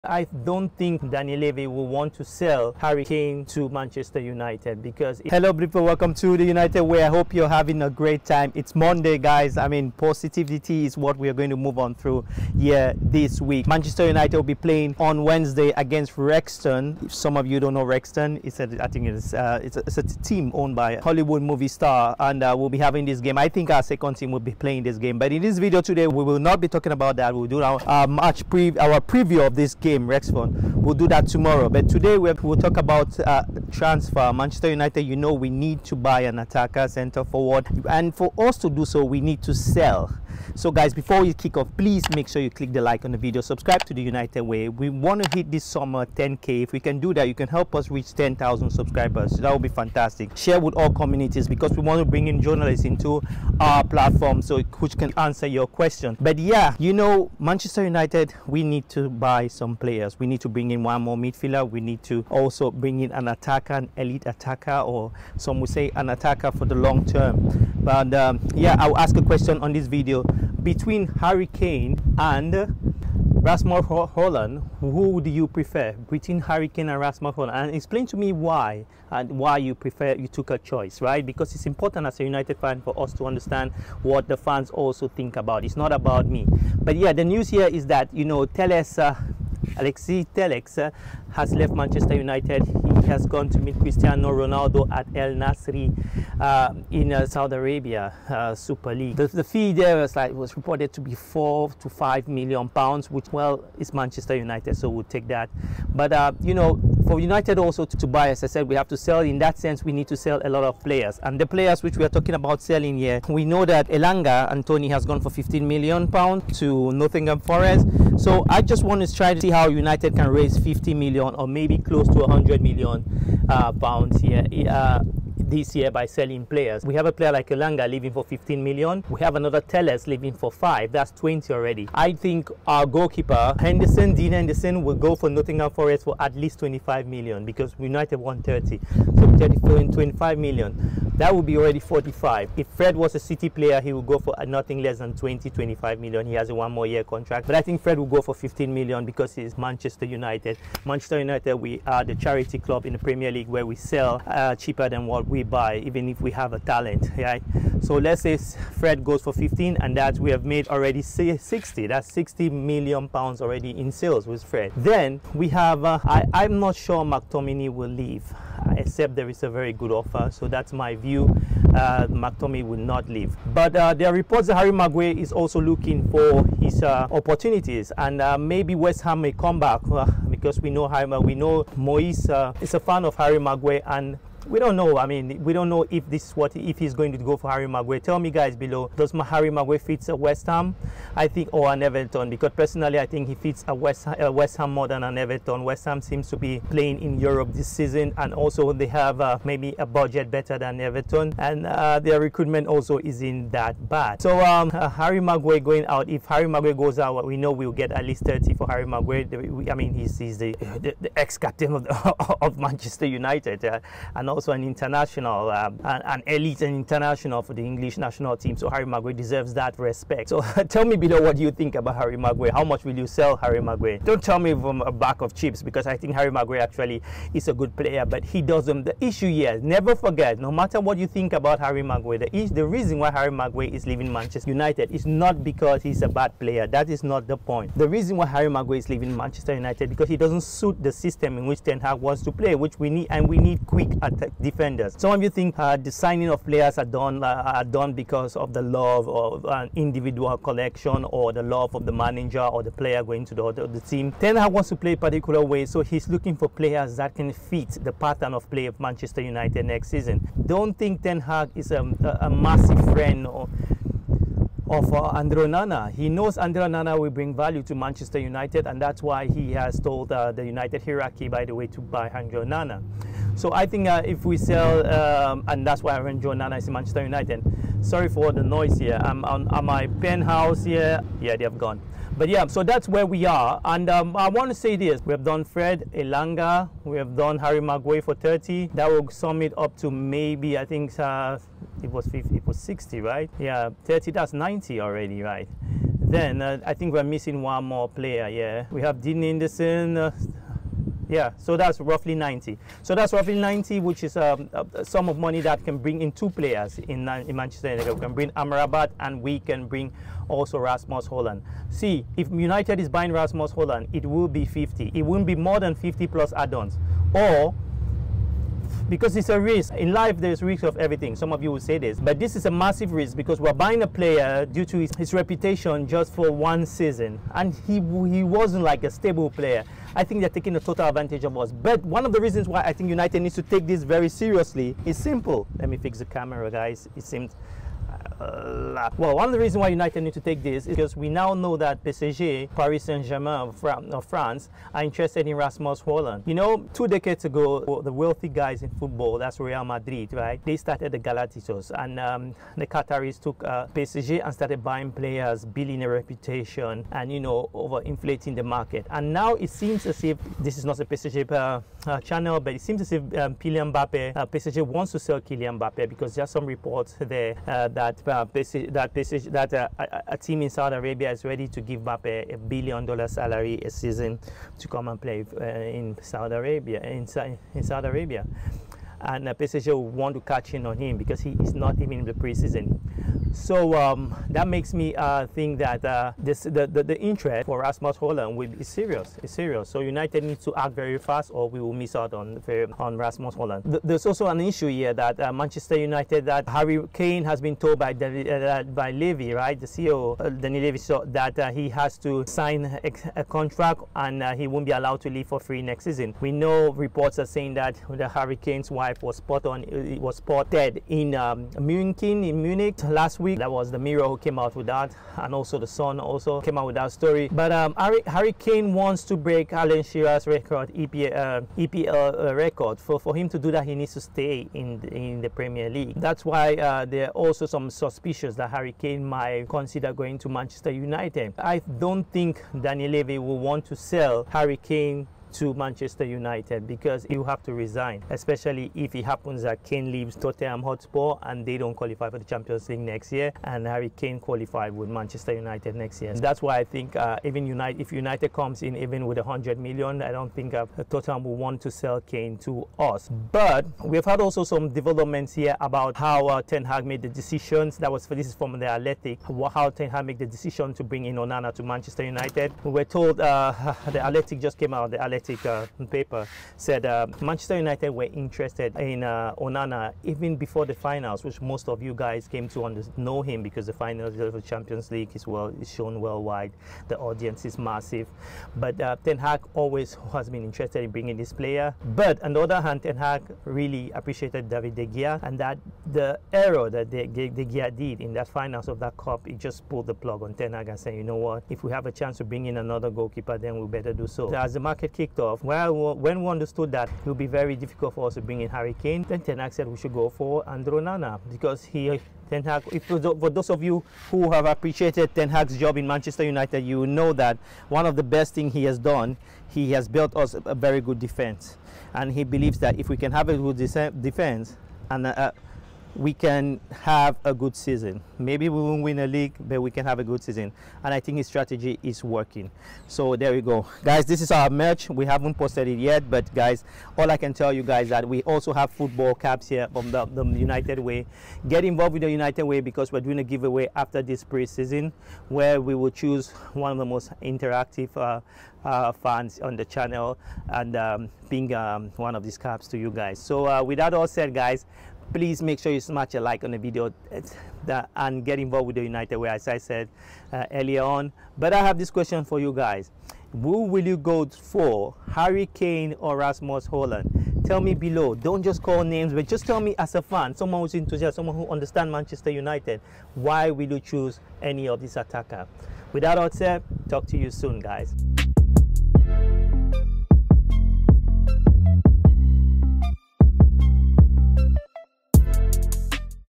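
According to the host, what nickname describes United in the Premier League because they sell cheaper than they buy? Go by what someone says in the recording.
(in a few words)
the charity club.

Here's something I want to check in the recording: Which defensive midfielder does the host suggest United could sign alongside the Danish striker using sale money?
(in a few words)
Amrabat.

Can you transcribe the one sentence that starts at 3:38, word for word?
So Harry Maguire deserves that respect.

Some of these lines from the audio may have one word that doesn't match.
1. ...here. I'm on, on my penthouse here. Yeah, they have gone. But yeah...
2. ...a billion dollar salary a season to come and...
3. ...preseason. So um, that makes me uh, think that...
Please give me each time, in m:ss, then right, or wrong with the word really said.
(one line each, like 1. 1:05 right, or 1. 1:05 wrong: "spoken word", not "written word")
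1. 4:38 right
2. 6:12 right
3. 6:22 right.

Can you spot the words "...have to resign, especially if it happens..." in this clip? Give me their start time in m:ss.
7:17.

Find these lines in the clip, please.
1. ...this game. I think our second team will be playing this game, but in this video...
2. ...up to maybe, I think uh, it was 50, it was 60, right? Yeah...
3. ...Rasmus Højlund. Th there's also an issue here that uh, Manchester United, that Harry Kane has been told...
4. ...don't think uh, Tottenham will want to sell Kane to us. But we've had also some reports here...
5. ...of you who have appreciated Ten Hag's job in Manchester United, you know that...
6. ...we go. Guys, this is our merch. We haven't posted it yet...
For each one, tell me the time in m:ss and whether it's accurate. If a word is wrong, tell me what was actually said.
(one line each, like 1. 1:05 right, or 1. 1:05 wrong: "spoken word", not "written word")
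1. 0:23 right
2. 4:49 right
3. 6:32 right
4. 7:30 wrong: "developments", not "reports"
5. 8:23 right
6. 8:43 right.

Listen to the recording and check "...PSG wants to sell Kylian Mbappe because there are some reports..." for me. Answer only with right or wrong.
right.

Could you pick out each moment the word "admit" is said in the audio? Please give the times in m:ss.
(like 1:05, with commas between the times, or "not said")
not said.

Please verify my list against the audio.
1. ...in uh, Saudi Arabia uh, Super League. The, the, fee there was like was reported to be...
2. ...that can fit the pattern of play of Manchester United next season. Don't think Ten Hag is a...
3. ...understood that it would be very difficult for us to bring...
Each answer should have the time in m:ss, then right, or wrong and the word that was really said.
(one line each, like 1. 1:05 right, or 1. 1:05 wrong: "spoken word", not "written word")
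1. 1:36 right
2. 4:16 right
3. 8:16 right.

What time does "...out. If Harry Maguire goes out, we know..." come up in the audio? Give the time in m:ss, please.
3:25.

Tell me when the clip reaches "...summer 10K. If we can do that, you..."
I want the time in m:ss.
0:45.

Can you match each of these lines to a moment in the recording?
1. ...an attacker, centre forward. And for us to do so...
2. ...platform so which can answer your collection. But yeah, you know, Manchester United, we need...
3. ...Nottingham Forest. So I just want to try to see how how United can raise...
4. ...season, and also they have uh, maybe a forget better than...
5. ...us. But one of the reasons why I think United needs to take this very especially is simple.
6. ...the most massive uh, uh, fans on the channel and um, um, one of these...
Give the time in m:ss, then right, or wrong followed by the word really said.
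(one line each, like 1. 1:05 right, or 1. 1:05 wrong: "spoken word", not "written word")
1. 0:36 right
2. 0:53 wrong: "question", not "collection"
3. 1:56 right
4. 3:17 wrong: "budget", not "forget"
5. 5:31 wrong: "seriously", not "especially"
6. 8:56 wrong: "interactive", not "massive".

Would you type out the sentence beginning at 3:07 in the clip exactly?
Tell me, guys, below does Harry Maguire fits a West Ham?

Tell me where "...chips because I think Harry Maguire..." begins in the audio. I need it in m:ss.
3:45.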